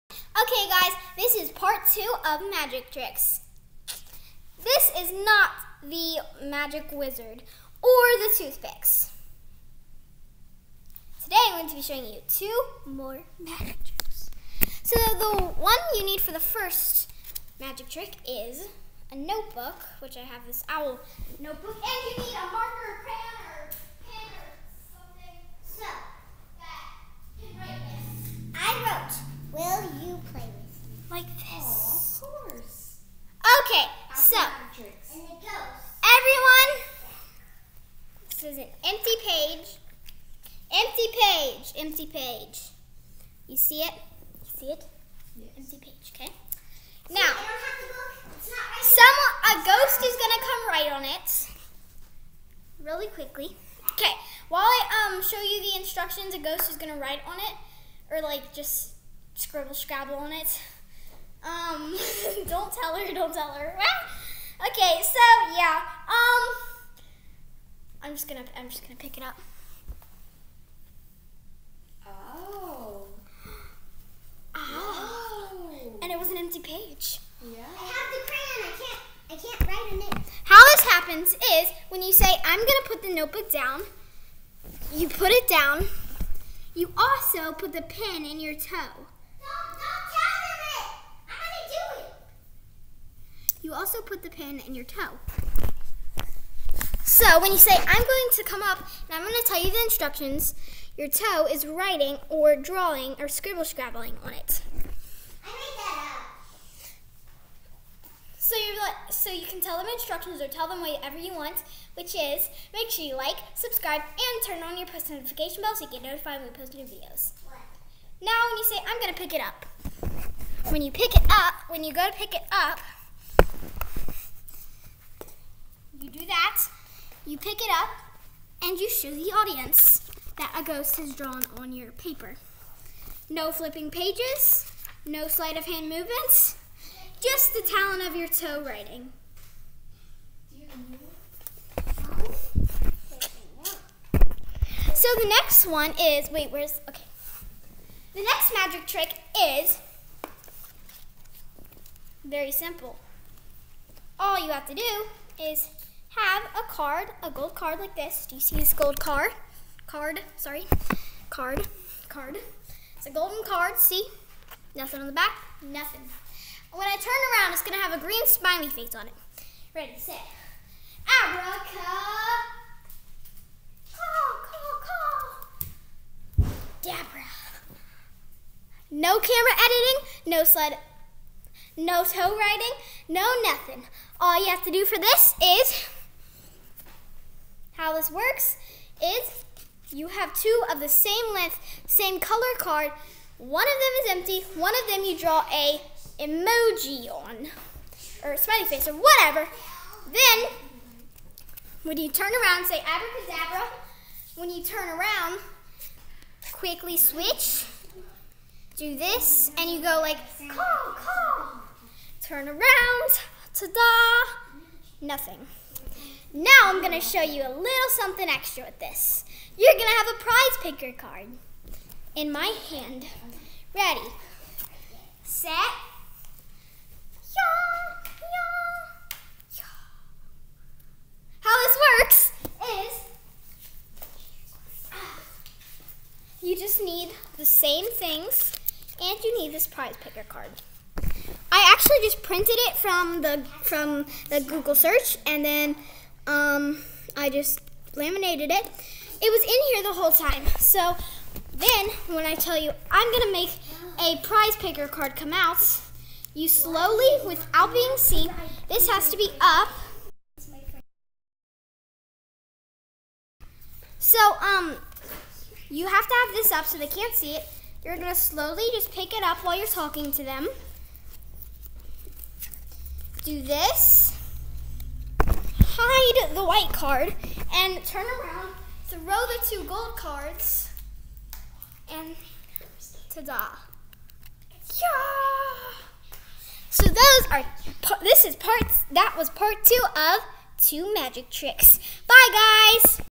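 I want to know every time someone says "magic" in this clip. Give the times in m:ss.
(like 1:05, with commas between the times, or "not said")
0:02, 0:06, 0:13, 0:17, 2:28, 4:50.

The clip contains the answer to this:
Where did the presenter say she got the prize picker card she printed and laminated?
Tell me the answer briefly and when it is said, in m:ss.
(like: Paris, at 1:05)
Google search, at 4:04.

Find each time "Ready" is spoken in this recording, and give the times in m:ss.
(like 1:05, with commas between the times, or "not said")
2:49, 3:43.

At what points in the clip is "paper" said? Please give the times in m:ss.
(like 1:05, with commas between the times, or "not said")
2:11.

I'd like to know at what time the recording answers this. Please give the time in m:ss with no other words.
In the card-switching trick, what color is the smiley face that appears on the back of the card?
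2:48.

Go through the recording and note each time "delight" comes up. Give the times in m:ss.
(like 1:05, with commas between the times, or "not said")
not said.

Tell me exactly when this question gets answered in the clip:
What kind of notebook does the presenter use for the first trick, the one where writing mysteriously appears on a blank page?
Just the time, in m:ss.
0:20.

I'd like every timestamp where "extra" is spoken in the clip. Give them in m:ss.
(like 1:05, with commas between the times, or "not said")
3:38.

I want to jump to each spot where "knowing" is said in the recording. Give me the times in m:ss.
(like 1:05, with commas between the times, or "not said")
not said.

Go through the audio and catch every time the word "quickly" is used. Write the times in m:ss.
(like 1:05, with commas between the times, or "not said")
0:53, 3:26.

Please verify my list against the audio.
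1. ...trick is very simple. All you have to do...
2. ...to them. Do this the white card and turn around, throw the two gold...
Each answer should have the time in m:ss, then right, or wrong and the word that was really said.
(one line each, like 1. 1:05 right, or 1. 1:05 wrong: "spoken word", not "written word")
1. 2:28 right
2. 4:30 right.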